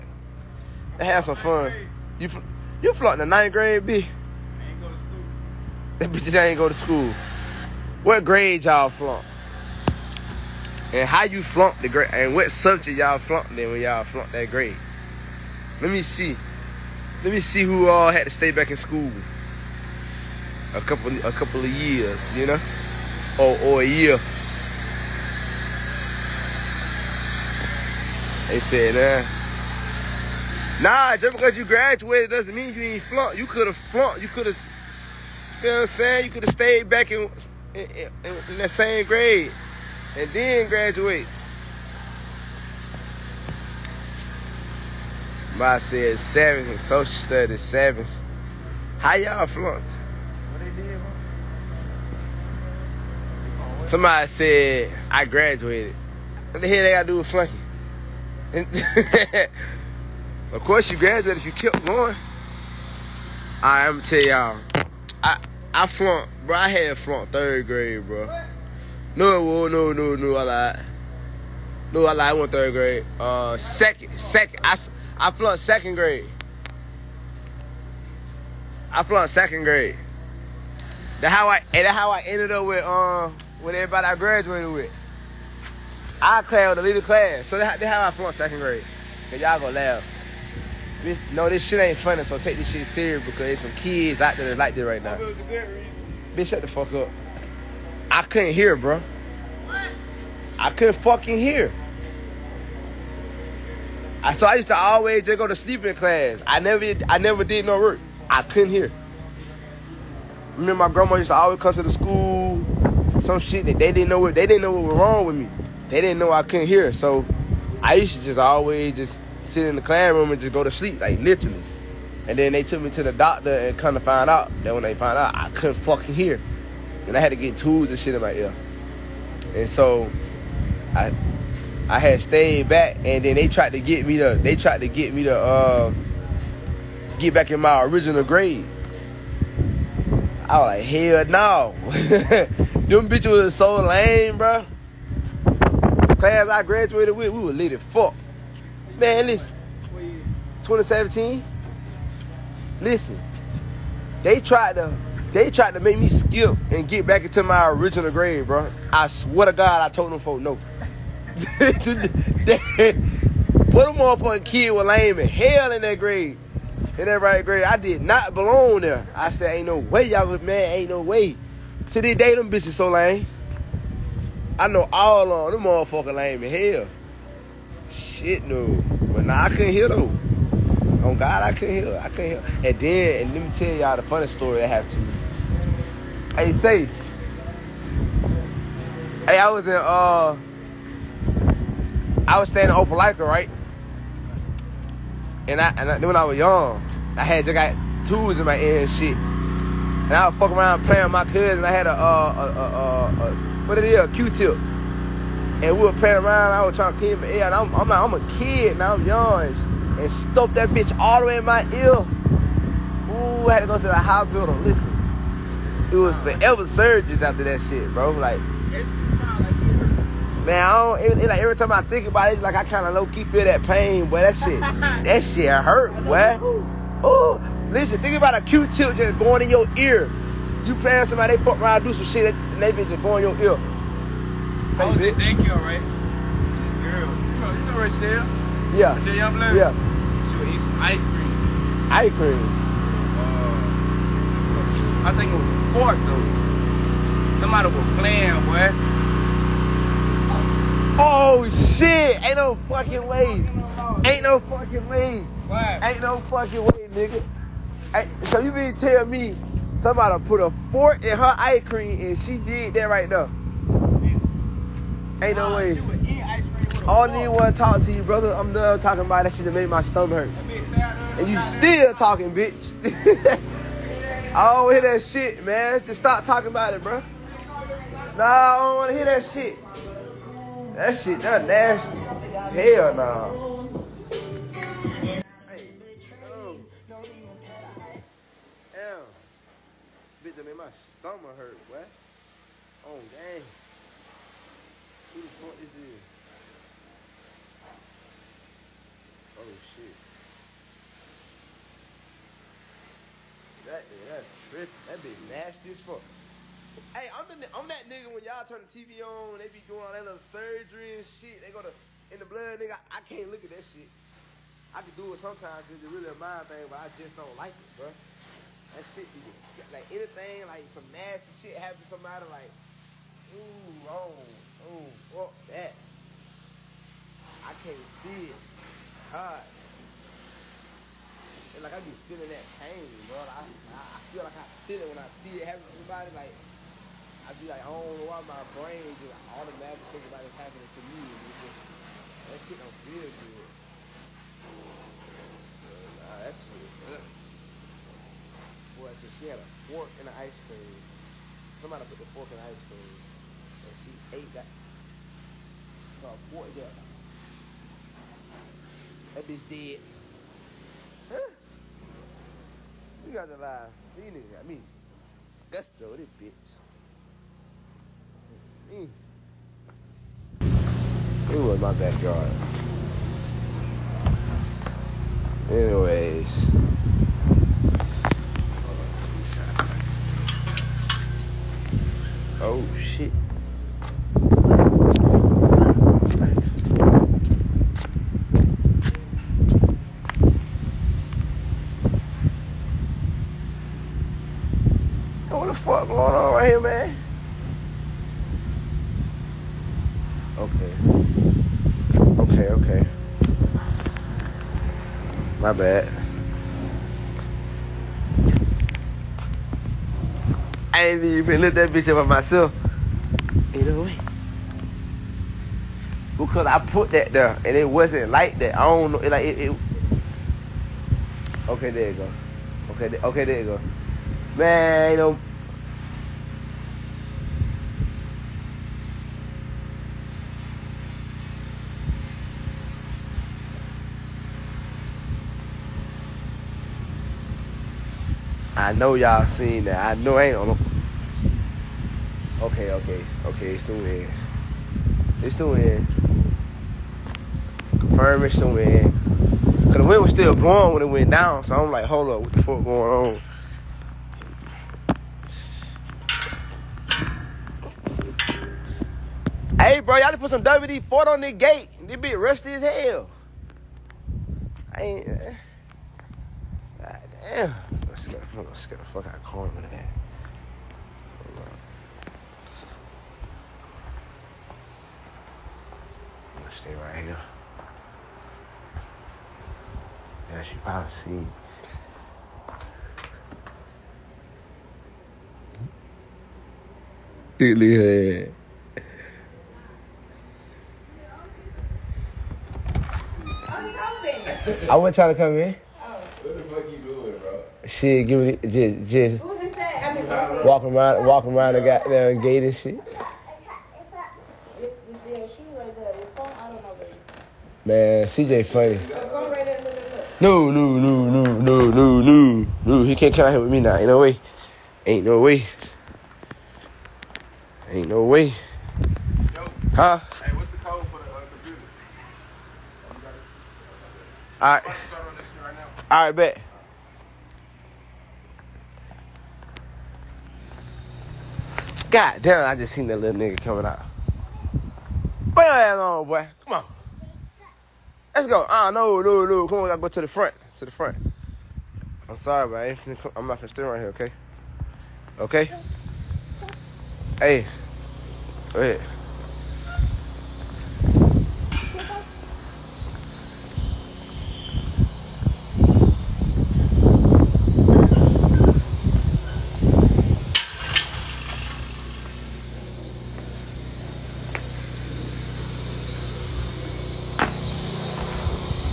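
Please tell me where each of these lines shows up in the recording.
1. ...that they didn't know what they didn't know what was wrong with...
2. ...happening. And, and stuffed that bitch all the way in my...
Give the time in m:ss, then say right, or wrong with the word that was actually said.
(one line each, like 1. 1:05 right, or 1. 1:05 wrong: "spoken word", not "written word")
1. 1:53 right
2. 3:29 wrong: "young", not "happening".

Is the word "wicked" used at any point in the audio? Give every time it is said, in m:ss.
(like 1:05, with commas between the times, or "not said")
not said.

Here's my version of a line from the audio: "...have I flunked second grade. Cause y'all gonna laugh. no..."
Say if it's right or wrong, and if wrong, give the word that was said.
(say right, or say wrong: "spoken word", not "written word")
right.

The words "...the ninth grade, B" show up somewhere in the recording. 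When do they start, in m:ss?
0:03.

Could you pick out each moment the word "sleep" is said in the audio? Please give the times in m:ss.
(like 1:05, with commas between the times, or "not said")
1:45, 2:00.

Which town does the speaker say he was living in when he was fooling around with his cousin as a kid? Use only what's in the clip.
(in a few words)
Opelika.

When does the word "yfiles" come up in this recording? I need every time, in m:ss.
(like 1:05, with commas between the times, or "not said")
not said.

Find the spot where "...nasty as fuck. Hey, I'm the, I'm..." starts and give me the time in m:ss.
5:05.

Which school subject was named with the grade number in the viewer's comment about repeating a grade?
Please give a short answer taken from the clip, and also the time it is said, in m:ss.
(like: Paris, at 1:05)
Social studies, at 0:46.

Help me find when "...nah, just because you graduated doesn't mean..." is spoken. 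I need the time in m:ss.
0:30.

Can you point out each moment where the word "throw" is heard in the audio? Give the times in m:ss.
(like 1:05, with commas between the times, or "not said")
not said.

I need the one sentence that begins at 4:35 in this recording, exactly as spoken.
Just stop talking about it, bro.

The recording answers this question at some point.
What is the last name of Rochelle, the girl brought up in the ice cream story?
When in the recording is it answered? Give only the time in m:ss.
3:59.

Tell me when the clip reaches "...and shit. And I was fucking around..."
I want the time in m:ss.
3:18.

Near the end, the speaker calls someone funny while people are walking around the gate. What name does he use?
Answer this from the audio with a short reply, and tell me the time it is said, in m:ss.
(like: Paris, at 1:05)
CJ, at 8:28.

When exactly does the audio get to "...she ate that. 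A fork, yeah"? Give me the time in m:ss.
5:53.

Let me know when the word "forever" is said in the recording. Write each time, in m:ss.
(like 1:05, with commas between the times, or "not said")
3:36.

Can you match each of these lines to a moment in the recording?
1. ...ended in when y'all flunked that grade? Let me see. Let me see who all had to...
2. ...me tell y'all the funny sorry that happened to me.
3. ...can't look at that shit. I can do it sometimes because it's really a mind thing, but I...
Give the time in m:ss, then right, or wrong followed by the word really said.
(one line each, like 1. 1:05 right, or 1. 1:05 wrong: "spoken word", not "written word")
1. 0:13 wrong: "flunked", not "ended"
2. 3:03 wrong: "story", not "sorry"
3. 5:13 right.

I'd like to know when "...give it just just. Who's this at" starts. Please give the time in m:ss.
8:18.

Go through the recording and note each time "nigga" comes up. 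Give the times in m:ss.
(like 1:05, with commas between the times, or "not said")
4:16, 5:07, 5:12, 6:04, 8:53.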